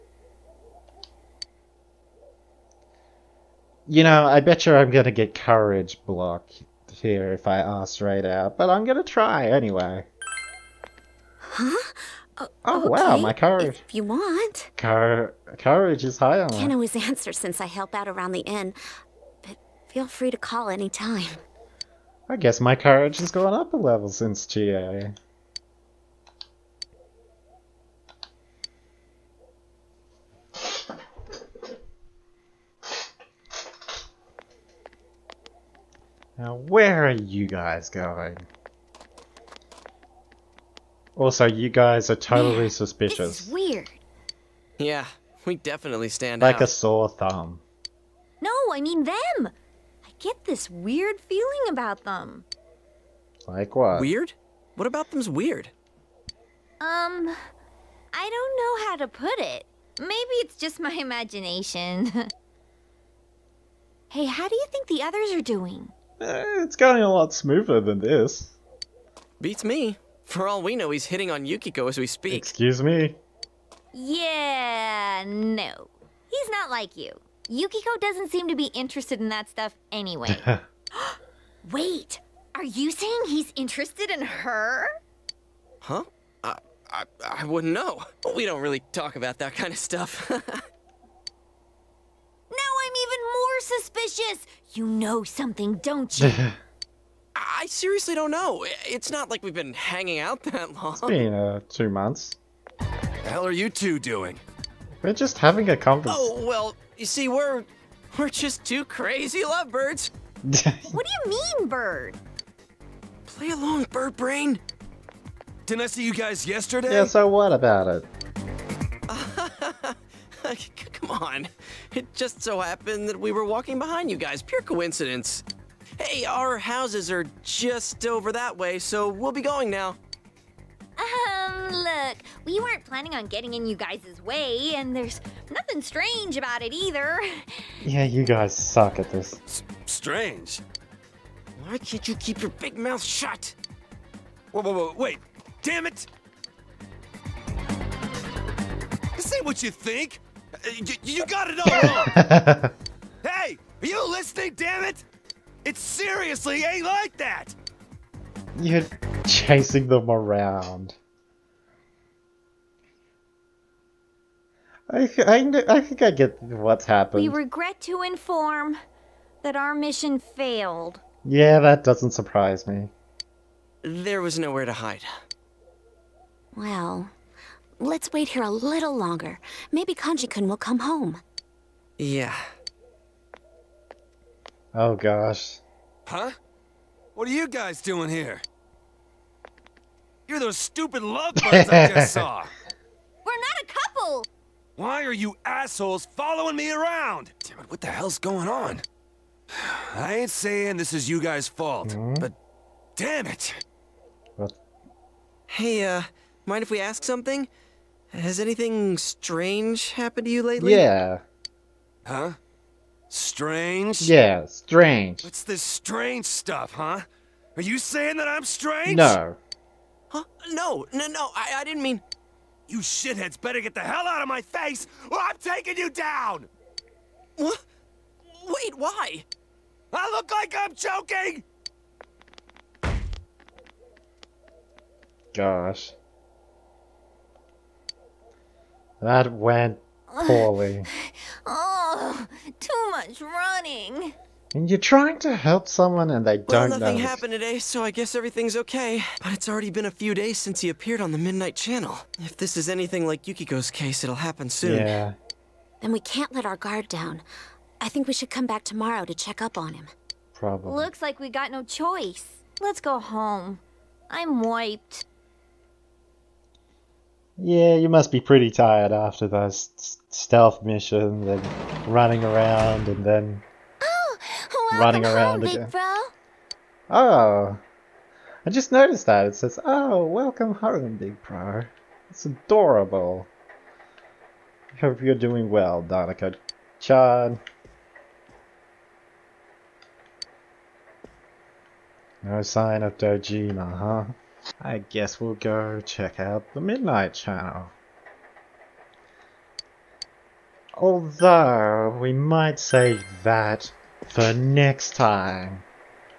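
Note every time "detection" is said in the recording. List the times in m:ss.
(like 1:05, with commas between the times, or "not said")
not said.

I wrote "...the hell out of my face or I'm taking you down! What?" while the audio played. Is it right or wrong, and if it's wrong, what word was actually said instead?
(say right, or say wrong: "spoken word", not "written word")
right.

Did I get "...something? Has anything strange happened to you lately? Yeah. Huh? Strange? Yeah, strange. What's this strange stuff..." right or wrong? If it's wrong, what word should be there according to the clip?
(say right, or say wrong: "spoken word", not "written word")
right.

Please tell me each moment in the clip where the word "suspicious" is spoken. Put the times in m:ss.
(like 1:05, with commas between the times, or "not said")
0:42, 1:33.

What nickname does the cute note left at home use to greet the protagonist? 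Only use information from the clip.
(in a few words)
Big Bro.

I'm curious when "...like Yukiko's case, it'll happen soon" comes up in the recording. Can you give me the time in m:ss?
4:13.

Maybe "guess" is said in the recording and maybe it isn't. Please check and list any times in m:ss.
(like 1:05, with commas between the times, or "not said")
0:22, 4:07, 4:54.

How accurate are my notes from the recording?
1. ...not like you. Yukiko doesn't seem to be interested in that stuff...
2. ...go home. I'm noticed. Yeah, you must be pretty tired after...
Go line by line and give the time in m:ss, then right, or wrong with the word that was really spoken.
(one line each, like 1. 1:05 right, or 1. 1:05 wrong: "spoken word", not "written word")
1. 1:16 right
2. 4:22 wrong: "wiped", not "noticed".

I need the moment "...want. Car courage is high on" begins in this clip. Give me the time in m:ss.
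0:14.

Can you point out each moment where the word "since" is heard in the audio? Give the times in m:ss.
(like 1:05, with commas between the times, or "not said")
0:17, 0:24, 4:10.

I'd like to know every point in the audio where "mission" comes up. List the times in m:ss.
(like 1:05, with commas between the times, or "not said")
2:49, 4:30.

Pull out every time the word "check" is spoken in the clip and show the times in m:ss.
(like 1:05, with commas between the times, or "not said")
4:19, 4:55.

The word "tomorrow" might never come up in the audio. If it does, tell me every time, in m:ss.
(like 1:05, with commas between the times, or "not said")
4:18.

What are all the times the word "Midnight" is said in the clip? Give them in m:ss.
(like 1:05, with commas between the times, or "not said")
4:11, 4:56.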